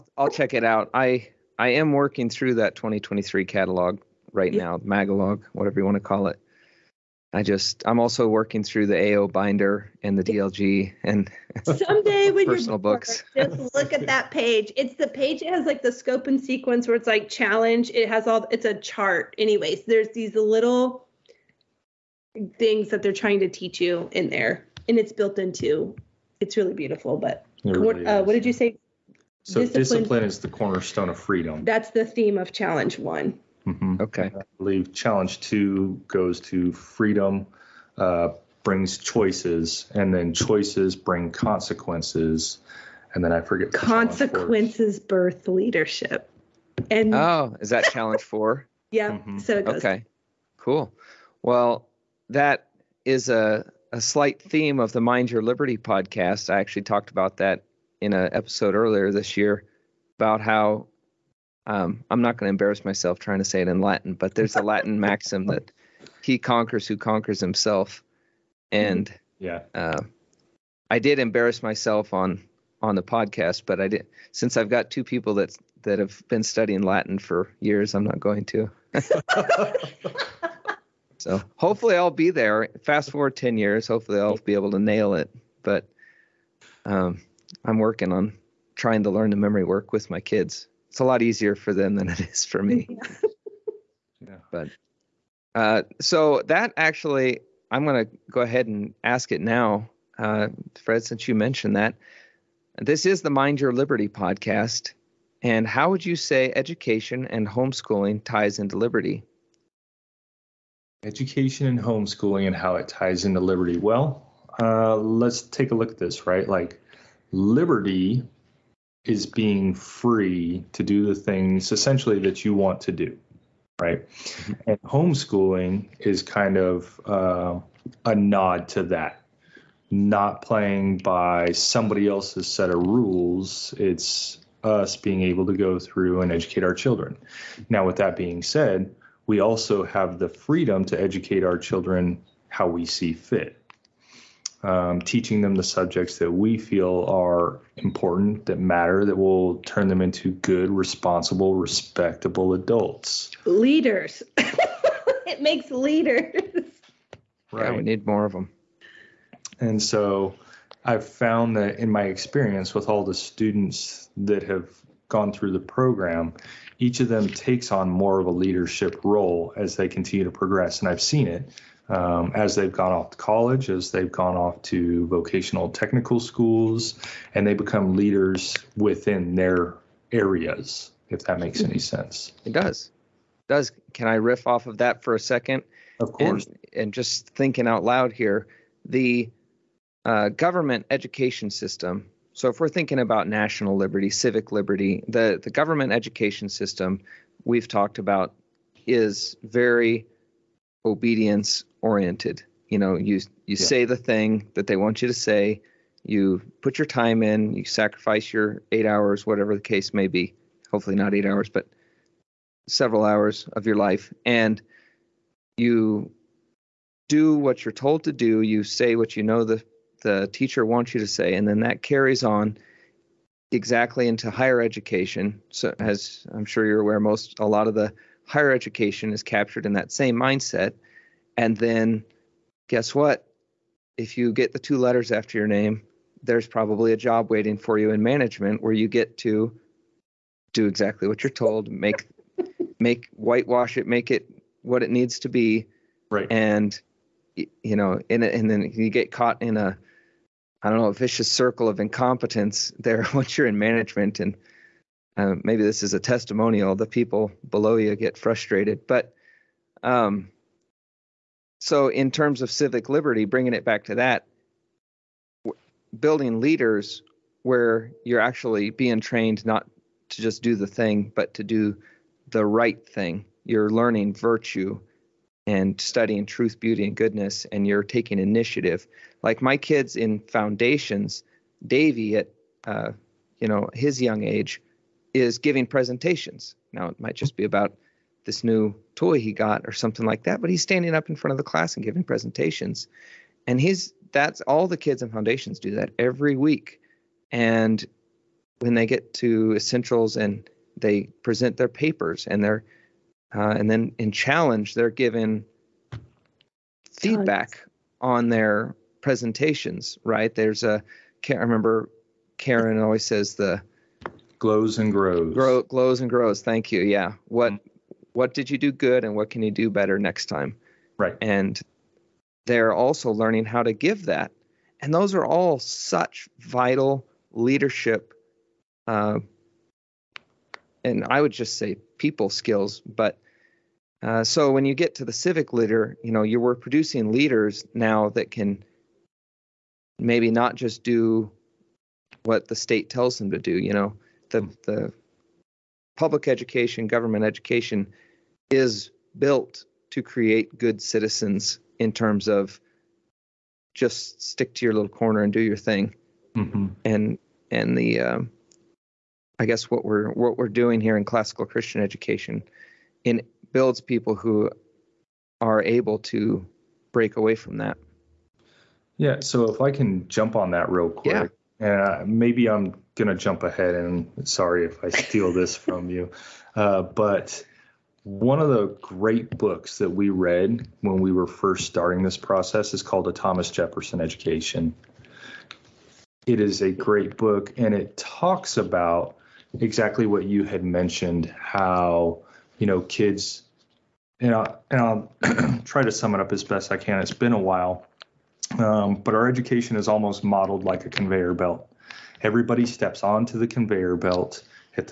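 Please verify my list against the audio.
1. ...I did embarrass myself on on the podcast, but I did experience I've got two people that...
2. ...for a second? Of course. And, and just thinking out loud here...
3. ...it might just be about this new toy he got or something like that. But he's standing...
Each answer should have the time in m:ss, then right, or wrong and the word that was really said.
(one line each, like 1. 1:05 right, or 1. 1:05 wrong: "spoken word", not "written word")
1. 1:10 wrong: "since", not "experience"
2. 3:05 right
3. 4:46 right.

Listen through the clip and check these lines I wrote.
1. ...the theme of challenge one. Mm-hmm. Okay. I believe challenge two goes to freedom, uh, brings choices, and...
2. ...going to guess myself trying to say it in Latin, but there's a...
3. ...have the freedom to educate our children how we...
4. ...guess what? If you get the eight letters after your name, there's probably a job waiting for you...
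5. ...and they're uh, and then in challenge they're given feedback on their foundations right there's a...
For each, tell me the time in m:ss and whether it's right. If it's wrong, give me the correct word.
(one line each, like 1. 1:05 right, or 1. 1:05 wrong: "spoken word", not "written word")
1. 0:31 right
2. 1:02 wrong: "embarrass", not "guess"
3. 2:19 right
4. 3:52 wrong: "two", not "eight"
5. 5:02 wrong: "presentations", not "foundations".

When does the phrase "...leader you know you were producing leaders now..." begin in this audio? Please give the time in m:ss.
5:35.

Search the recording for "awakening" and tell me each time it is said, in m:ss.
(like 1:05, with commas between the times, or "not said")
not said.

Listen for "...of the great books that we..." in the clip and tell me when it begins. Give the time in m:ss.
6:18.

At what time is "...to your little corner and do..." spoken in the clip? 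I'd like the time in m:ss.
5:54.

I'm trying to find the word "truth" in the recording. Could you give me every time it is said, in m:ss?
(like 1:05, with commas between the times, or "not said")
4:36.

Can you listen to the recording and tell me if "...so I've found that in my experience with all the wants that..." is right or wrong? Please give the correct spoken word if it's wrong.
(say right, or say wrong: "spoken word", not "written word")
wrong: "students", not "wants".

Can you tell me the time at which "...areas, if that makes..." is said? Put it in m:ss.
3:00.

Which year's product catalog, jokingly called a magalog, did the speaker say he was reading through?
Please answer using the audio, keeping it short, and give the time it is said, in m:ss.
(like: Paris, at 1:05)
2023, at 0:02.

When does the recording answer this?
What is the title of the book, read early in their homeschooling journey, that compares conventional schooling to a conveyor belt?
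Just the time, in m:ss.
6:23.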